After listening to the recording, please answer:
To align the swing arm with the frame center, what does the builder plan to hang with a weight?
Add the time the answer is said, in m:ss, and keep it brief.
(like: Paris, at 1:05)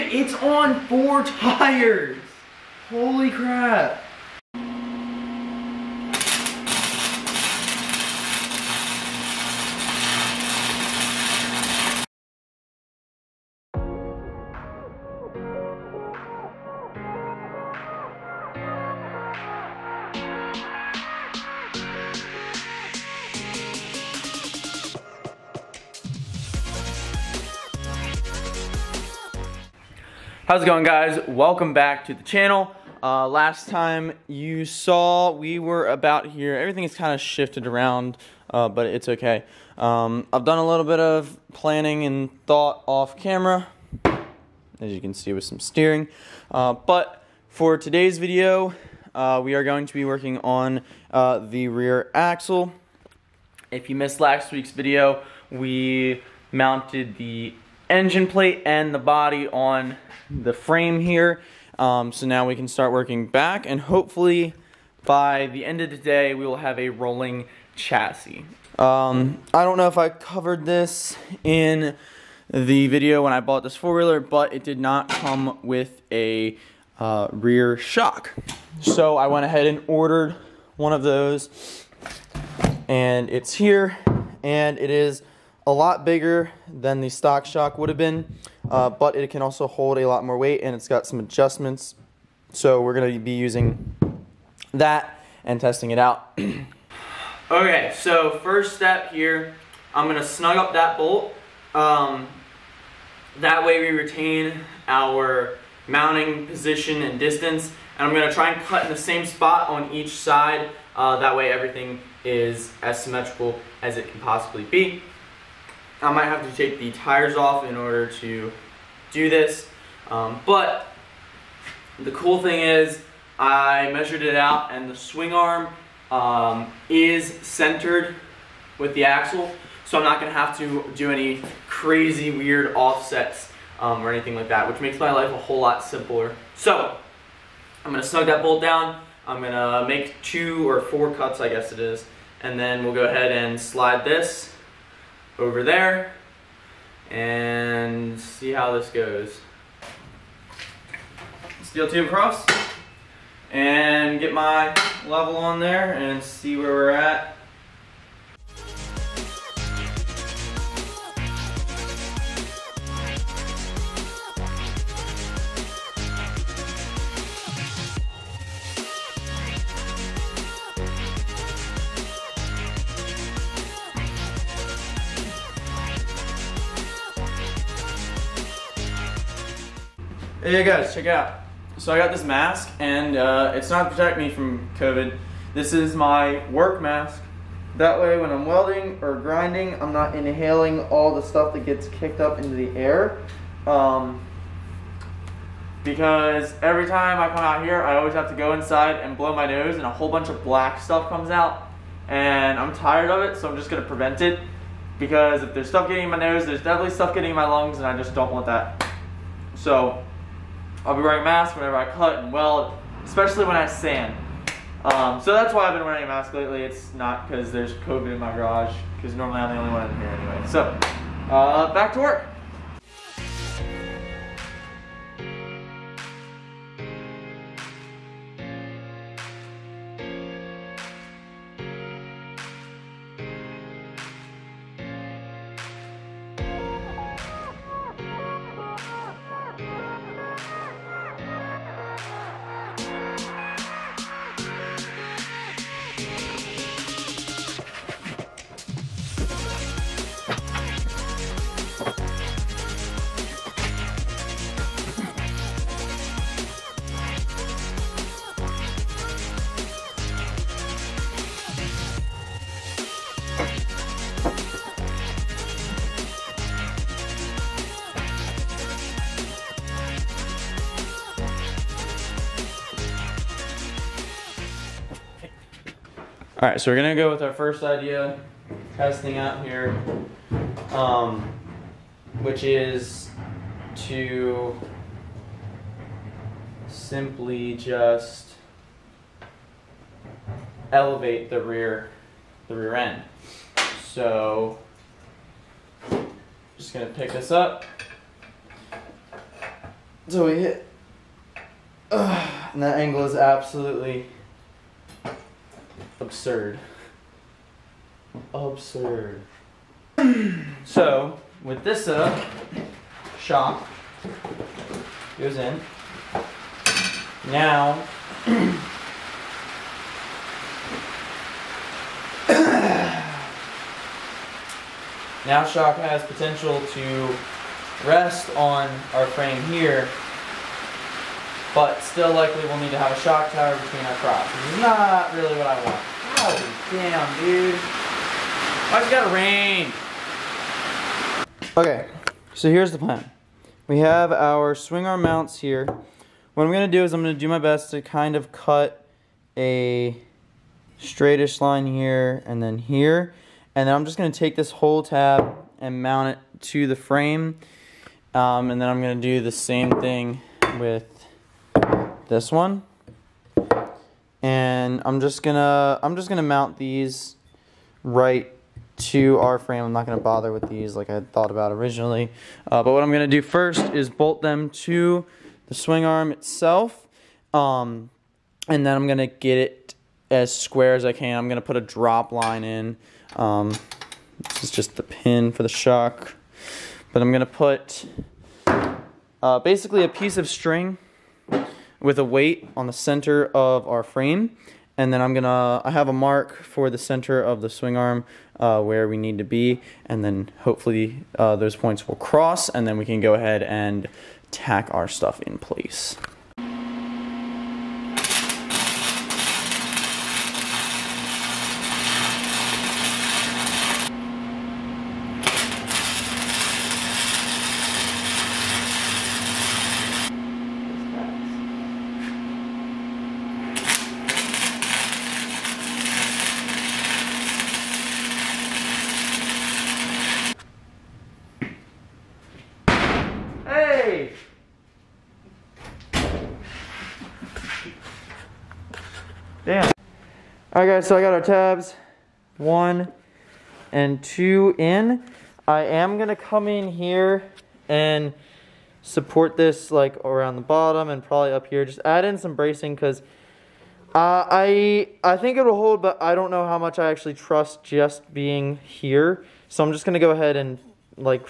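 a piece of string, at 6:29.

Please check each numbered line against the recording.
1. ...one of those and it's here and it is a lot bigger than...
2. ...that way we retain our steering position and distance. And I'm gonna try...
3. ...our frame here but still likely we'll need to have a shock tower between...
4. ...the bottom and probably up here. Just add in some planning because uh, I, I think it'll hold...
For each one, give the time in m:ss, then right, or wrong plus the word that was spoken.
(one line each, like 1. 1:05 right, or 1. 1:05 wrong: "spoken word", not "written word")
1. 1:20 right
2. 1:43 wrong: "mounting", not "steering"
3. 5:28 right
4. 7:30 wrong: "bracing", not "planning".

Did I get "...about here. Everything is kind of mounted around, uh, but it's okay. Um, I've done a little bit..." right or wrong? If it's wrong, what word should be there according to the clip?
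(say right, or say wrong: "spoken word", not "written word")
wrong: "shifted", not "mounted".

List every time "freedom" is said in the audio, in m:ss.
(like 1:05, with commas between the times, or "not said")
not said.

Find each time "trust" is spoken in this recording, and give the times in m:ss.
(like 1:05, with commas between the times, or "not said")
7:37.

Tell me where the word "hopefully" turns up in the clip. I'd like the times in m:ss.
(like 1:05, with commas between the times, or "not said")
1:03, 6:40.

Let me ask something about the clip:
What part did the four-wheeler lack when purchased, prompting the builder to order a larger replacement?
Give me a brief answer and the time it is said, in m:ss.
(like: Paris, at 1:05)
rear shock, at 1:17.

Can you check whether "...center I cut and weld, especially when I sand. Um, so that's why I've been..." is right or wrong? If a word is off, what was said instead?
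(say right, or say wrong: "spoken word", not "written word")
wrong: "whenever", not "center".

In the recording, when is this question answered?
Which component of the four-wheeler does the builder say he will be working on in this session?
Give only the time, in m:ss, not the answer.
0:51.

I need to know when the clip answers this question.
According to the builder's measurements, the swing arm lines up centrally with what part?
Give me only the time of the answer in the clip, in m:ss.
2:08.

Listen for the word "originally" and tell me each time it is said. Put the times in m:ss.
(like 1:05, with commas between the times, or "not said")
6:11.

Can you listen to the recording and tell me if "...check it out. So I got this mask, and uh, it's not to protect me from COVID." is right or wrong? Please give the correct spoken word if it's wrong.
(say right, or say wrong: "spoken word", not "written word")
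right.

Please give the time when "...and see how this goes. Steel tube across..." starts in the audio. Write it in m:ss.
2:27.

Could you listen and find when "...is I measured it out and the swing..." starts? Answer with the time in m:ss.
2:02.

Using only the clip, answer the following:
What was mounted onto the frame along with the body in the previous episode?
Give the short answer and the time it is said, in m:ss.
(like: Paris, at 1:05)
engine plate, at 0:57.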